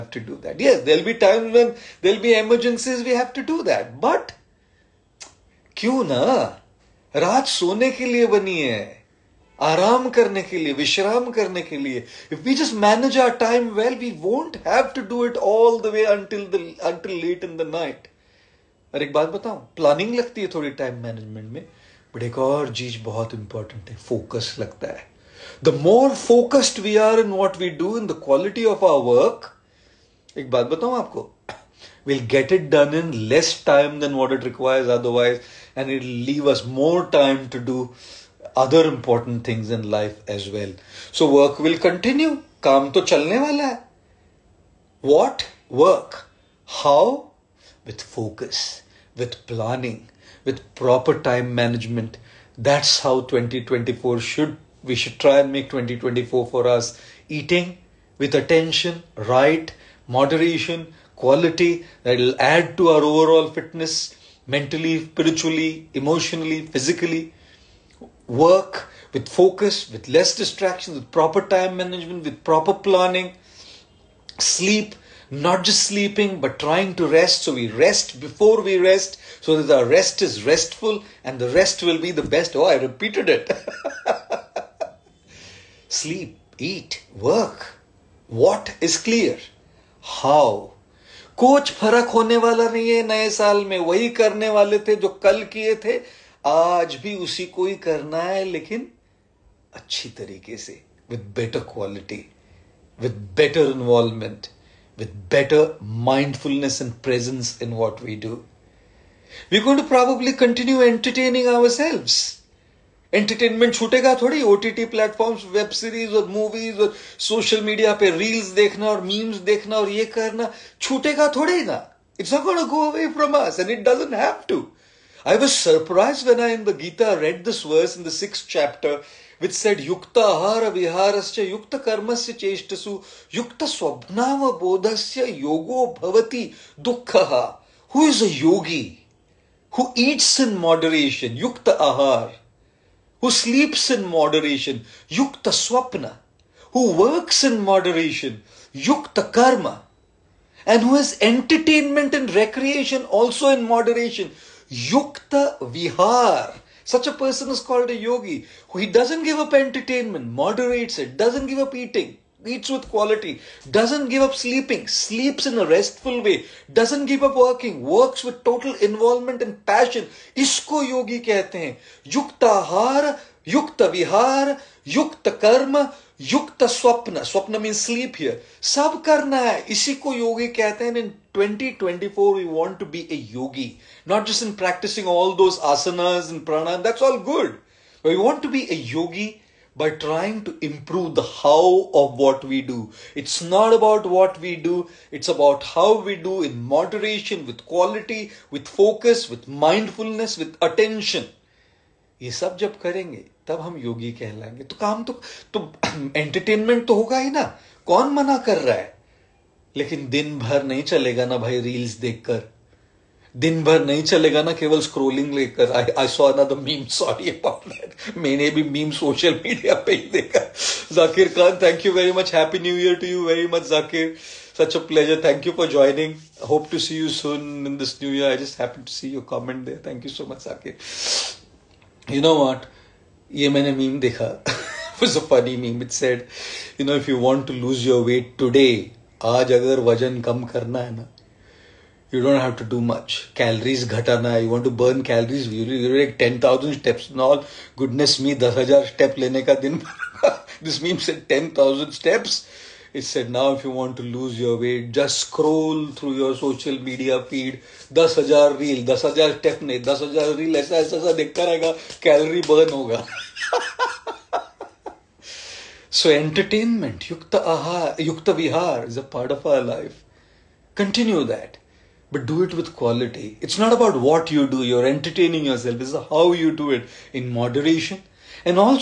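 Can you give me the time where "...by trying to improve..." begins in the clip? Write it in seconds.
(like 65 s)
189 s.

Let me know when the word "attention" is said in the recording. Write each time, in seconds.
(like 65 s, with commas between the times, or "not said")
58 s, 200 s.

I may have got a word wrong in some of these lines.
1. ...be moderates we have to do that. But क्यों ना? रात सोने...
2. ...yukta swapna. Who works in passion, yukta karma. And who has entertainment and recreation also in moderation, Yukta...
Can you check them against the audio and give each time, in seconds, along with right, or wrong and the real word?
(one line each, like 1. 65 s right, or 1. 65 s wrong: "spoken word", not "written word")
1. 2 s wrong: "emergencies", not "moderates"
2. 145 s wrong: "moderation", not "passion".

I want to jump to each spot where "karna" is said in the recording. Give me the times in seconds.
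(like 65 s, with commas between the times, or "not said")
179 s.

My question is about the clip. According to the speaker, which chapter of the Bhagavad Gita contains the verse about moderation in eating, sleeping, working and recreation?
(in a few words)
Sixth chapter.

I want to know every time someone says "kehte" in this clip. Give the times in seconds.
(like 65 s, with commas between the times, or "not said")
171 s, 180 s.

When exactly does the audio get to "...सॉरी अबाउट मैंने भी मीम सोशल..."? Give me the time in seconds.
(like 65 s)
216 s.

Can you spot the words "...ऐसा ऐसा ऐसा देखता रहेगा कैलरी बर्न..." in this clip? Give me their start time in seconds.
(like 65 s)
260 s.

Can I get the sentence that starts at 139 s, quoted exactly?
Who eats in moderation, yukta ahar.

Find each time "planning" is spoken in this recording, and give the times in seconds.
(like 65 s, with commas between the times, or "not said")
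49 s, 72 s.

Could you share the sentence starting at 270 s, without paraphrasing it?
Continue that, but do it with quality.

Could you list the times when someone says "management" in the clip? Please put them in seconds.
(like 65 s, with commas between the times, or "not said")
51 s, 71 s.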